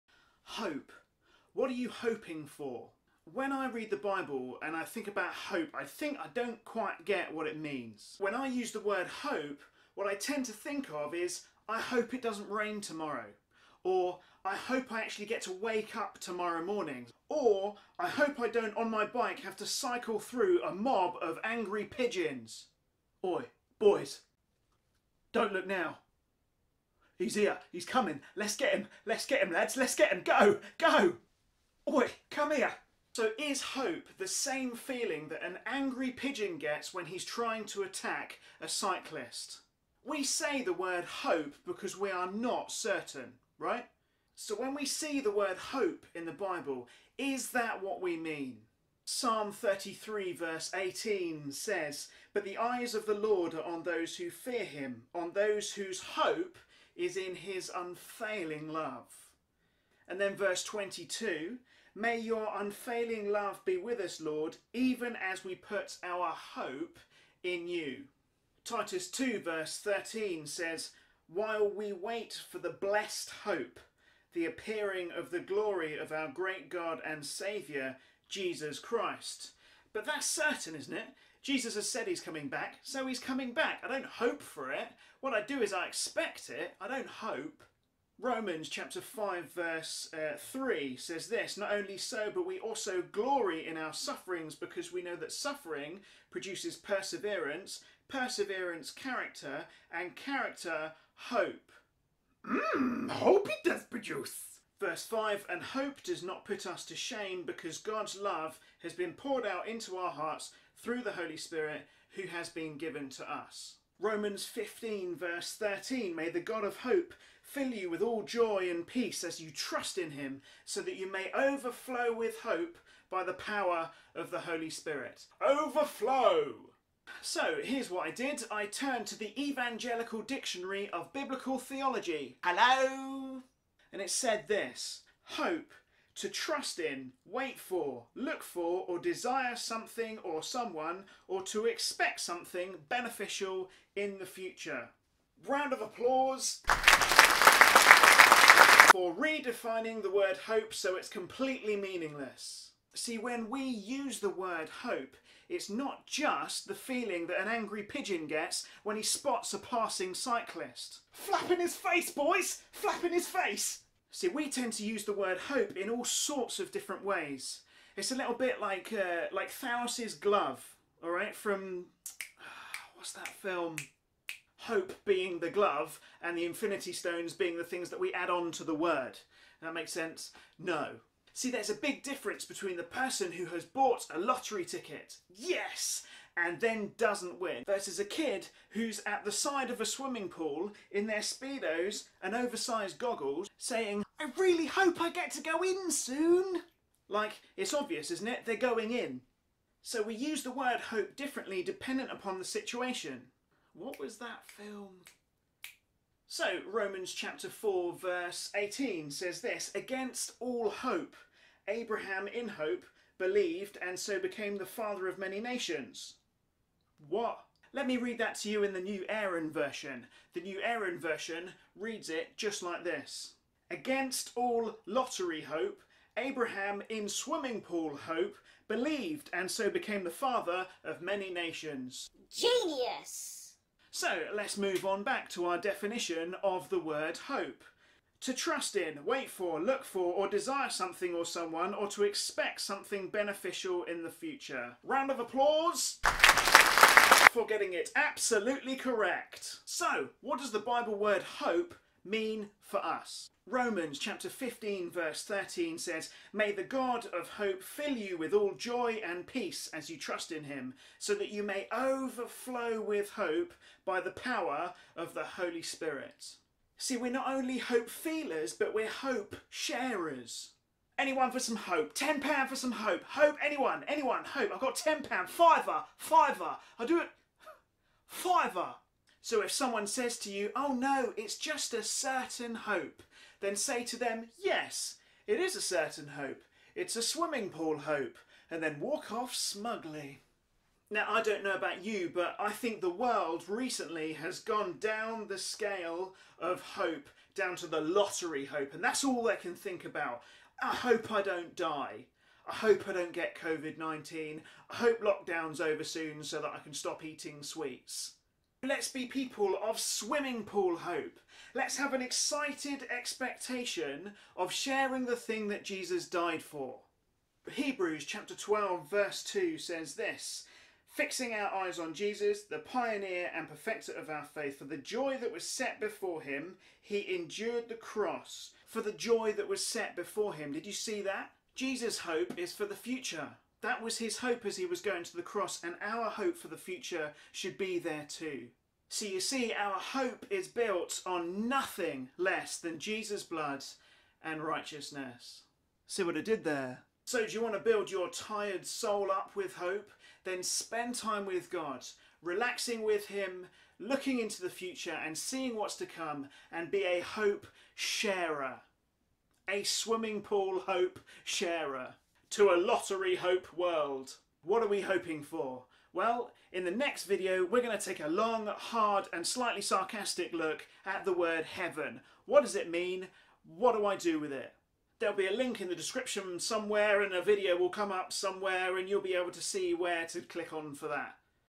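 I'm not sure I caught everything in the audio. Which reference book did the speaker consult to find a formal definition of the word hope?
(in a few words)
Evangelical Dictionary of Biblical Theology.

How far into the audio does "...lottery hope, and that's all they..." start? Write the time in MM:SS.
04:57.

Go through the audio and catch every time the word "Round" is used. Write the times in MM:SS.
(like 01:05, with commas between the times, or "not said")
02:25, 04:04.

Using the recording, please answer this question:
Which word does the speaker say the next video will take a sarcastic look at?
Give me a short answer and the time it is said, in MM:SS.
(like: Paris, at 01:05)
heaven, at 06:11.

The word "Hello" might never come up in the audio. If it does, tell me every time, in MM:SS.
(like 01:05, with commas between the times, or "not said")
02:12.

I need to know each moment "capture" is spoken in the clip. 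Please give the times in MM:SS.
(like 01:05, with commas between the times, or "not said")
not said.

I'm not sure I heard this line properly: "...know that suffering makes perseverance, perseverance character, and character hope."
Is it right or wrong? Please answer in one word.
wrong.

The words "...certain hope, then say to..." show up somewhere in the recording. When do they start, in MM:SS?
04:41.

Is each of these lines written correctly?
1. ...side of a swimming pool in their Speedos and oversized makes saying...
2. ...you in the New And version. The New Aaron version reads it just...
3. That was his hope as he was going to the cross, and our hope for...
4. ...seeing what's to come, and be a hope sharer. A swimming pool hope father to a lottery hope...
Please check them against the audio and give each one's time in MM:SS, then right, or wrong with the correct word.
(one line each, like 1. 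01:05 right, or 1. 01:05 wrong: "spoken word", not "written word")
1. 03:09 wrong: "goggles", not "makes"
2. 03:38 wrong: "Aaron", not "And"
3. 05:33 right
4. 05:55 wrong: "sharer", not "father".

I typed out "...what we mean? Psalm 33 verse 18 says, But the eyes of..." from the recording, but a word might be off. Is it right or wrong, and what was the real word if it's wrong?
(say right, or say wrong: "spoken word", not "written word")
right.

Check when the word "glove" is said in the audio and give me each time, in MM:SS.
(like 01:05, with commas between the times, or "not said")
02:50, 02:55.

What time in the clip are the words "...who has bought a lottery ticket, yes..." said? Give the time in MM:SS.
03:03.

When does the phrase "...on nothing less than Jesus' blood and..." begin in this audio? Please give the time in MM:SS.
05:41.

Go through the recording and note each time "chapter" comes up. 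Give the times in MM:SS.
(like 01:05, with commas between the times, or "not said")
01:28, 03:27, 04:13, 05:18.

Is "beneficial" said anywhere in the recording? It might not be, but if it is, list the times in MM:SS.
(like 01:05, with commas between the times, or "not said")
02:22, 04:03.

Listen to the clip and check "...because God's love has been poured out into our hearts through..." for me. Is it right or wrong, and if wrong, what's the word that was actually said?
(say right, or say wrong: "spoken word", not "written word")
right.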